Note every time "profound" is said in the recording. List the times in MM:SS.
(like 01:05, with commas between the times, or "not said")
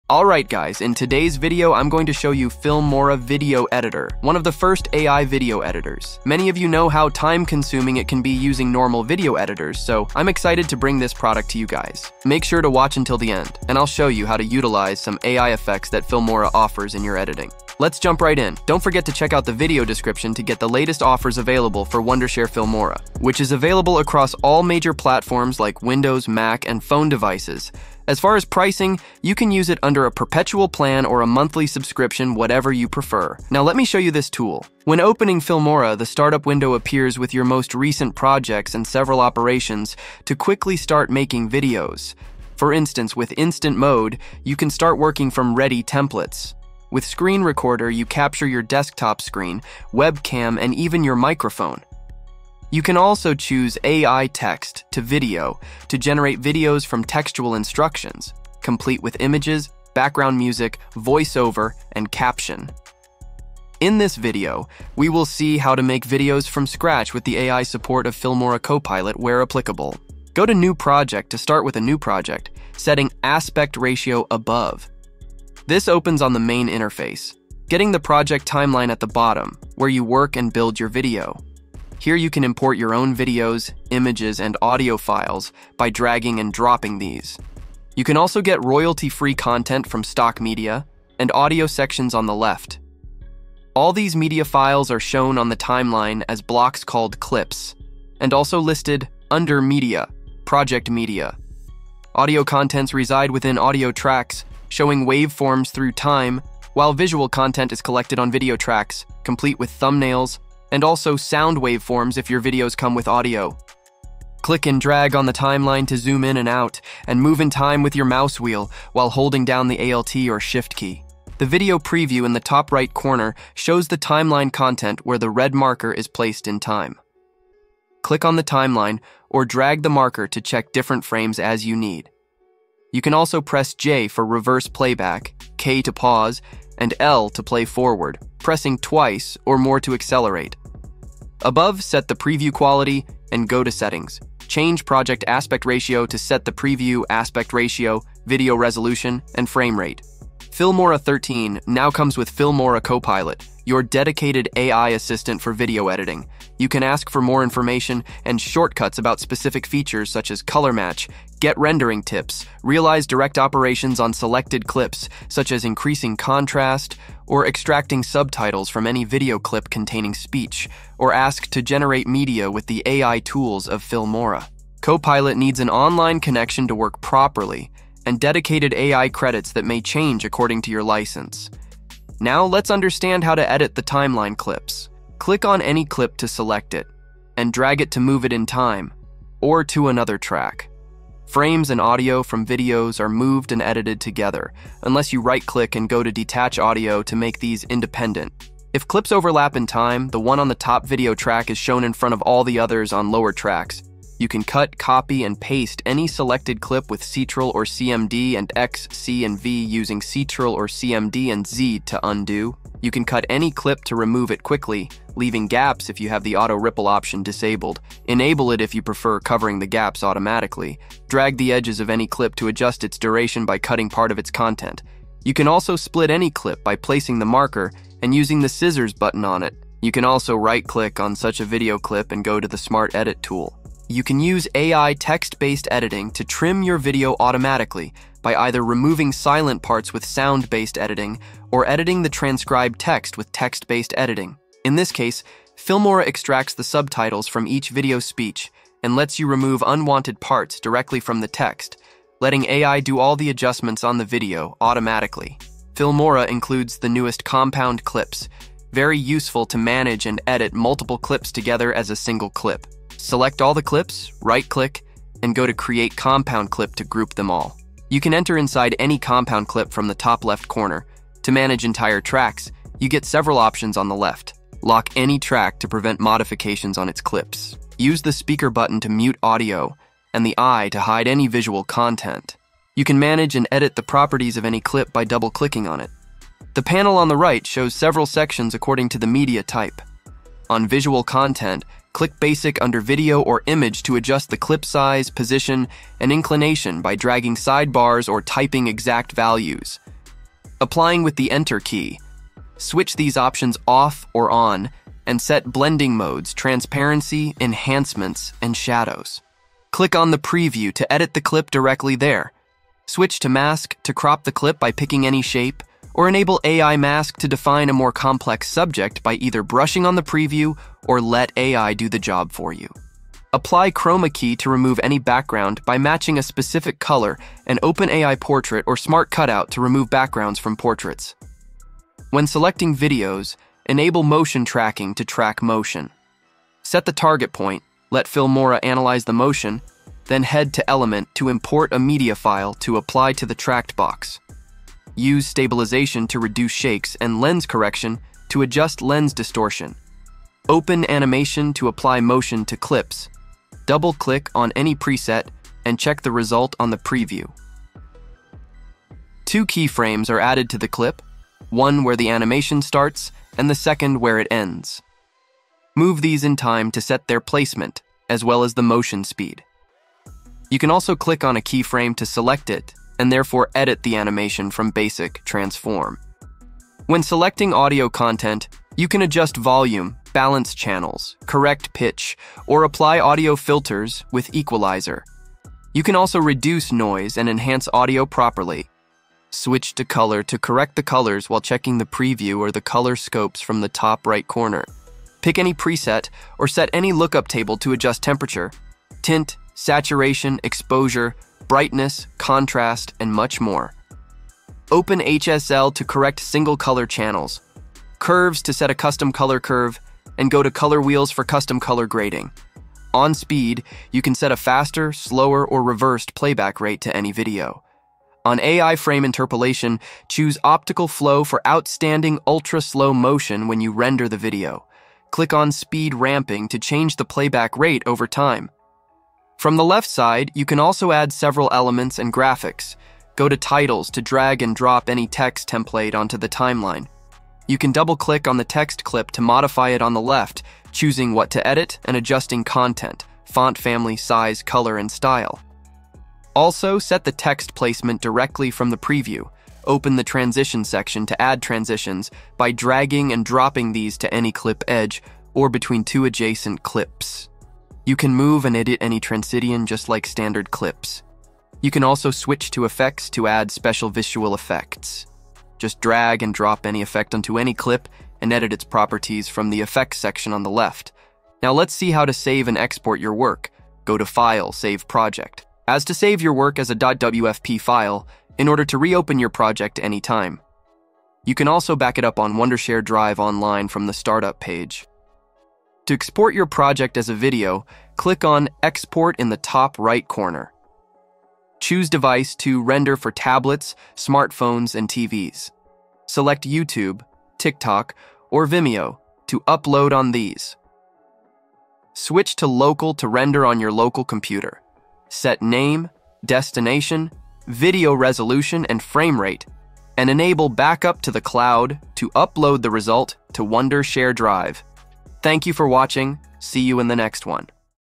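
not said.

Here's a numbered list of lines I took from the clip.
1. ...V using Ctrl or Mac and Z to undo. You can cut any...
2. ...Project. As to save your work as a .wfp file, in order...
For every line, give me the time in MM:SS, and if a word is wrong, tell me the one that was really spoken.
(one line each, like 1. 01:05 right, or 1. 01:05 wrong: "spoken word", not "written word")
1. 03:29 wrong: "CMD", not "Mac"
2. 07:54 right.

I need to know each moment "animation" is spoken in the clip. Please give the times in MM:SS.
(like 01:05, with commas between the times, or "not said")
05:50, 06:02, 06:13.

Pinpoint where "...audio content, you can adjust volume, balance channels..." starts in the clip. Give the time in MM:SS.
06:17.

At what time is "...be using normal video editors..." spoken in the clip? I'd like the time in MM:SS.
00:08.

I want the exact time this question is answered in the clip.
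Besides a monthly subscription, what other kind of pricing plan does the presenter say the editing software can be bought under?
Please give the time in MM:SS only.
00:30.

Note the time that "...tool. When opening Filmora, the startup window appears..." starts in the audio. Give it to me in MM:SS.
00:34.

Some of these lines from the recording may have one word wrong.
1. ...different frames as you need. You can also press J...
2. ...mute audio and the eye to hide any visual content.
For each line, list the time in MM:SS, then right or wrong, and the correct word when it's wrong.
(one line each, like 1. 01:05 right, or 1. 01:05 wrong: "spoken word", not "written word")
1. 02:10 right
2. 04:38 right.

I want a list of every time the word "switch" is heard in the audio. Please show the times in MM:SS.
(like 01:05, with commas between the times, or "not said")
05:02, 05:12, 06:29, 07:42, 08:21.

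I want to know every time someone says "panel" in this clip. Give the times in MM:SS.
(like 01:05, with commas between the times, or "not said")
04:46.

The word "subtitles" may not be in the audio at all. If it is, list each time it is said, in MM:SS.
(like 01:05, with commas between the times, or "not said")
02:48, 04:06.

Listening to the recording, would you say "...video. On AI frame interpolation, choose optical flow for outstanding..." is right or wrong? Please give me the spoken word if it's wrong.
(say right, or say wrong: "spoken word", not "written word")
right.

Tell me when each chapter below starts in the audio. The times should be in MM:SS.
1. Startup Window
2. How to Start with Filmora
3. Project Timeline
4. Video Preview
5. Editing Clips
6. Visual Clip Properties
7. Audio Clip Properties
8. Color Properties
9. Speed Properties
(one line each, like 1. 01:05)
1. 00:34
2. 01:11
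3. 01:33
4. 02:01
5. 03:01
6. 04:42
7. 06:13
8. 06:27
9. 06:50.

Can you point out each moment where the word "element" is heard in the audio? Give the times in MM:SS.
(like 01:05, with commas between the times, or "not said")
05:40, 07:11.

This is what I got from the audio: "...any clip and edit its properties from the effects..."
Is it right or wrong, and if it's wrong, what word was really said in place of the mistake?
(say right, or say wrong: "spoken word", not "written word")
right.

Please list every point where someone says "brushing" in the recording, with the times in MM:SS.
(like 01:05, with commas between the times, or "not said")
05:19.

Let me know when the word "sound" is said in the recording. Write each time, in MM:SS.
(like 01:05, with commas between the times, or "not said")
01:51, 04:00.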